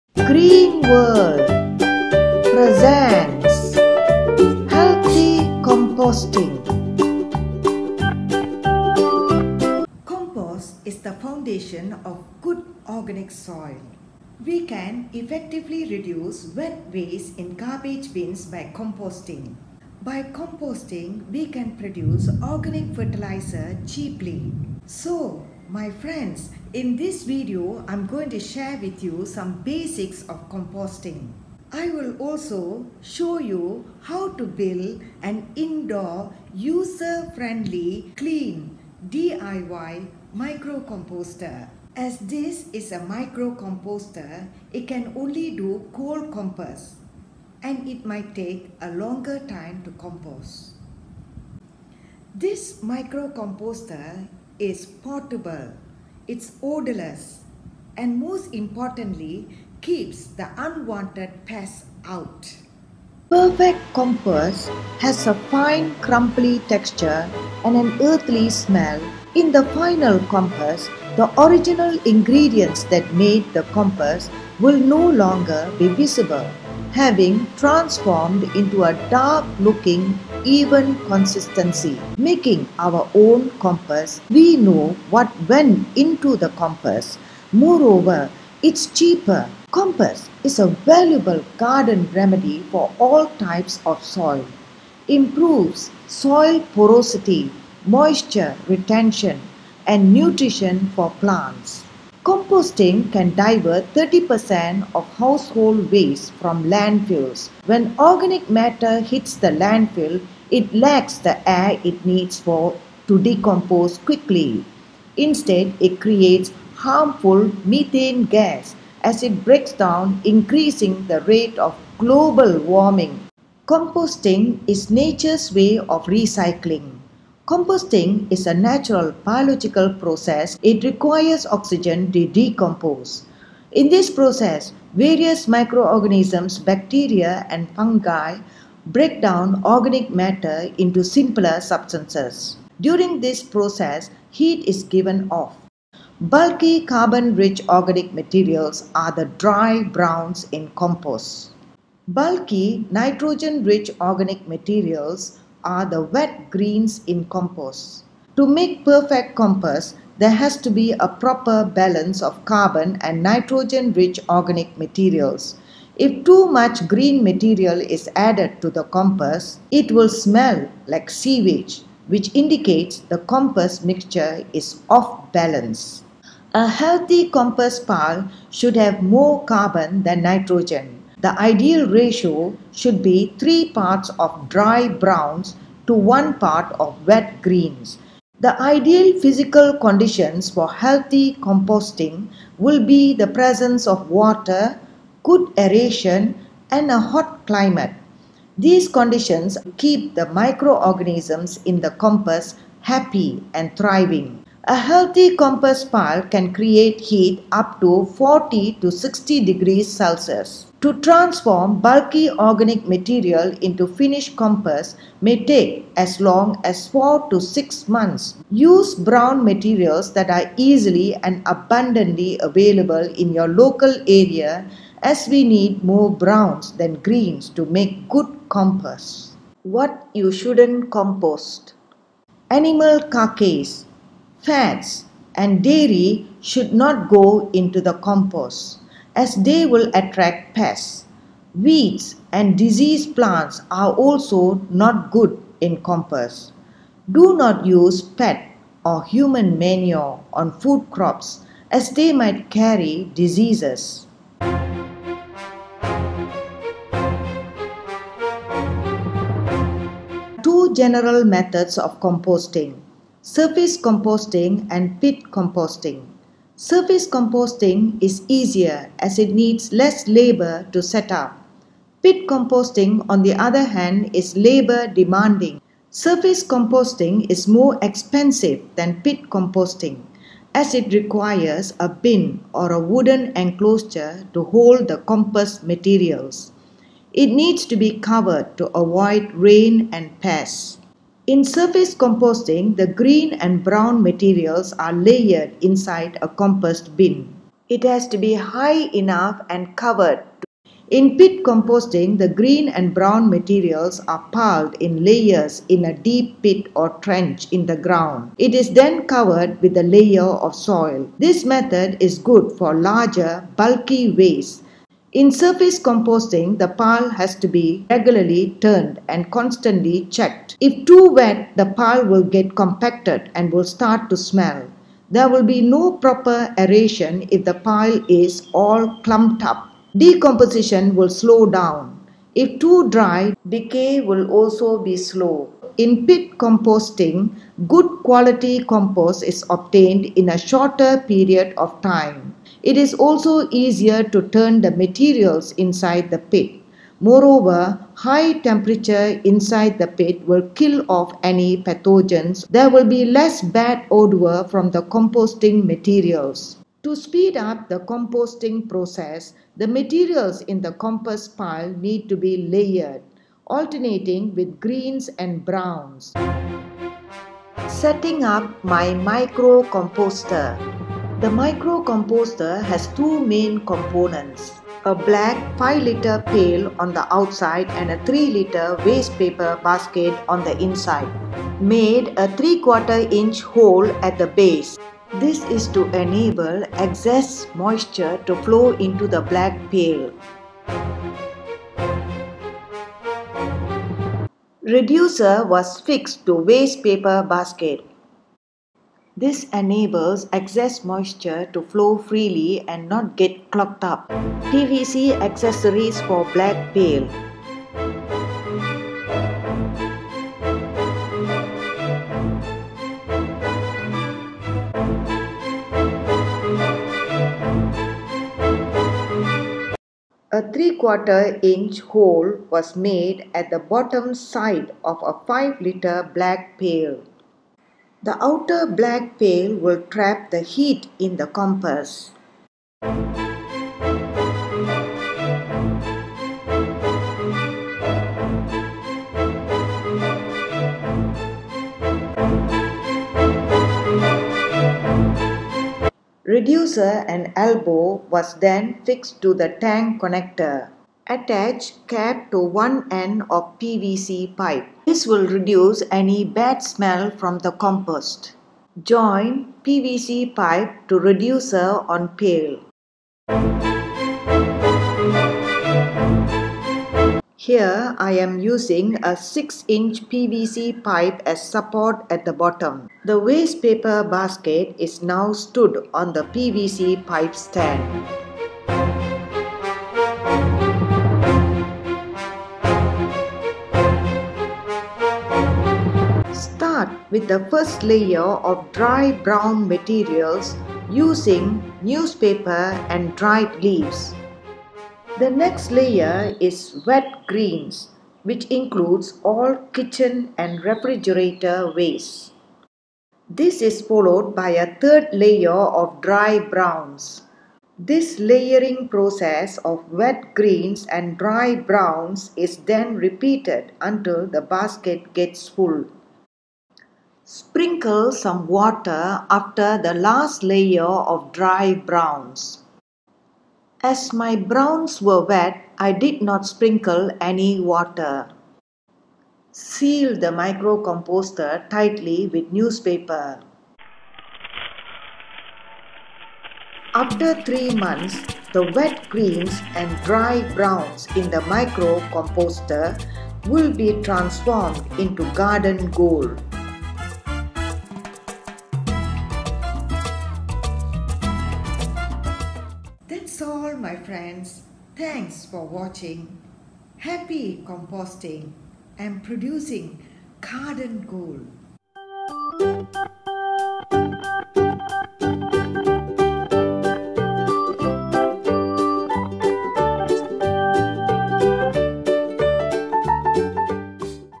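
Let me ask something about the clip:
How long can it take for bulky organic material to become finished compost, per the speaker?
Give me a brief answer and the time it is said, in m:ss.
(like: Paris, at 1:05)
4 to 6 months, at 3:36.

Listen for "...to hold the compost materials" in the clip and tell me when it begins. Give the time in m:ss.
4:44.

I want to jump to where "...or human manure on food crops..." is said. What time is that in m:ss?
4:08.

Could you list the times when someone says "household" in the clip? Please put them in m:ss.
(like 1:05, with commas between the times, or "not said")
1:45.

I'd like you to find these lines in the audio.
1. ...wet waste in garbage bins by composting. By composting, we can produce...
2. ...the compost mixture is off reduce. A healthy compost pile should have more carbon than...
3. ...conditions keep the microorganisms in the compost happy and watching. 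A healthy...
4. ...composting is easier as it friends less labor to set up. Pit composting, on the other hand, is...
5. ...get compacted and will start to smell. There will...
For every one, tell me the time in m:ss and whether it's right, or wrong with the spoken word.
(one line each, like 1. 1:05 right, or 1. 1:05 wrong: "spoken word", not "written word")
1. 0:16 right
2. 2:53 wrong: "balance", not "reduce"
3. 3:18 wrong: "thriving", not "watching"
4. 4:27 wrong: "needs", not "friends"
5. 5:22 right.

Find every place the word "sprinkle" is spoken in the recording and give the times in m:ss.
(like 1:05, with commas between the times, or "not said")
8:37, 8:46.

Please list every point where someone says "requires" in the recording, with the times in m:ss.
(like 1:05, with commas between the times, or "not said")
2:10, 4:40.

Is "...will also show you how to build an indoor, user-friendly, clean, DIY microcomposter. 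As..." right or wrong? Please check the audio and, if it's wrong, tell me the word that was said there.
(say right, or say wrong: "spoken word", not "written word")
right.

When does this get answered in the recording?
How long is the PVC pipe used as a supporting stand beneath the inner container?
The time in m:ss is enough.
7:49.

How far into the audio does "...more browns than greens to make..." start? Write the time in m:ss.
3:45.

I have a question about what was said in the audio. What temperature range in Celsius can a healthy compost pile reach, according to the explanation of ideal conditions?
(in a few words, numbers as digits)
40 to 60 degrees Celsius.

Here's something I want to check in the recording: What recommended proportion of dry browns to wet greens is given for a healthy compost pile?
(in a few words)
3 to 1.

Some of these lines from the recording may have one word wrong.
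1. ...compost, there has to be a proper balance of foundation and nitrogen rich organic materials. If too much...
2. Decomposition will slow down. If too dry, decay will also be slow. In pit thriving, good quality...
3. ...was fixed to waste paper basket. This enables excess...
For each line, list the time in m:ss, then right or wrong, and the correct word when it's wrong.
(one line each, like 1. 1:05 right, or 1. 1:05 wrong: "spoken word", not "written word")
1. 2:39 wrong: "carbon", not "foundation"
2. 5:29 wrong: "composting", not "thriving"
3. 6:35 right.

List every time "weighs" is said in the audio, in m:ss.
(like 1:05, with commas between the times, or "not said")
not said.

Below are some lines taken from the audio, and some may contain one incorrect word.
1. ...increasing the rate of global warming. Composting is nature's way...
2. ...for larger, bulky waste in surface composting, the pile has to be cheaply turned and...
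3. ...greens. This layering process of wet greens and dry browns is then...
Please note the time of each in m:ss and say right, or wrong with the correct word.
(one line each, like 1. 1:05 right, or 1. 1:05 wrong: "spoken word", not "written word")
1. 2:00 right
2. 5:12 wrong: "regularly", not "cheaply"
3. 8:26 wrong: "browns", not "greens".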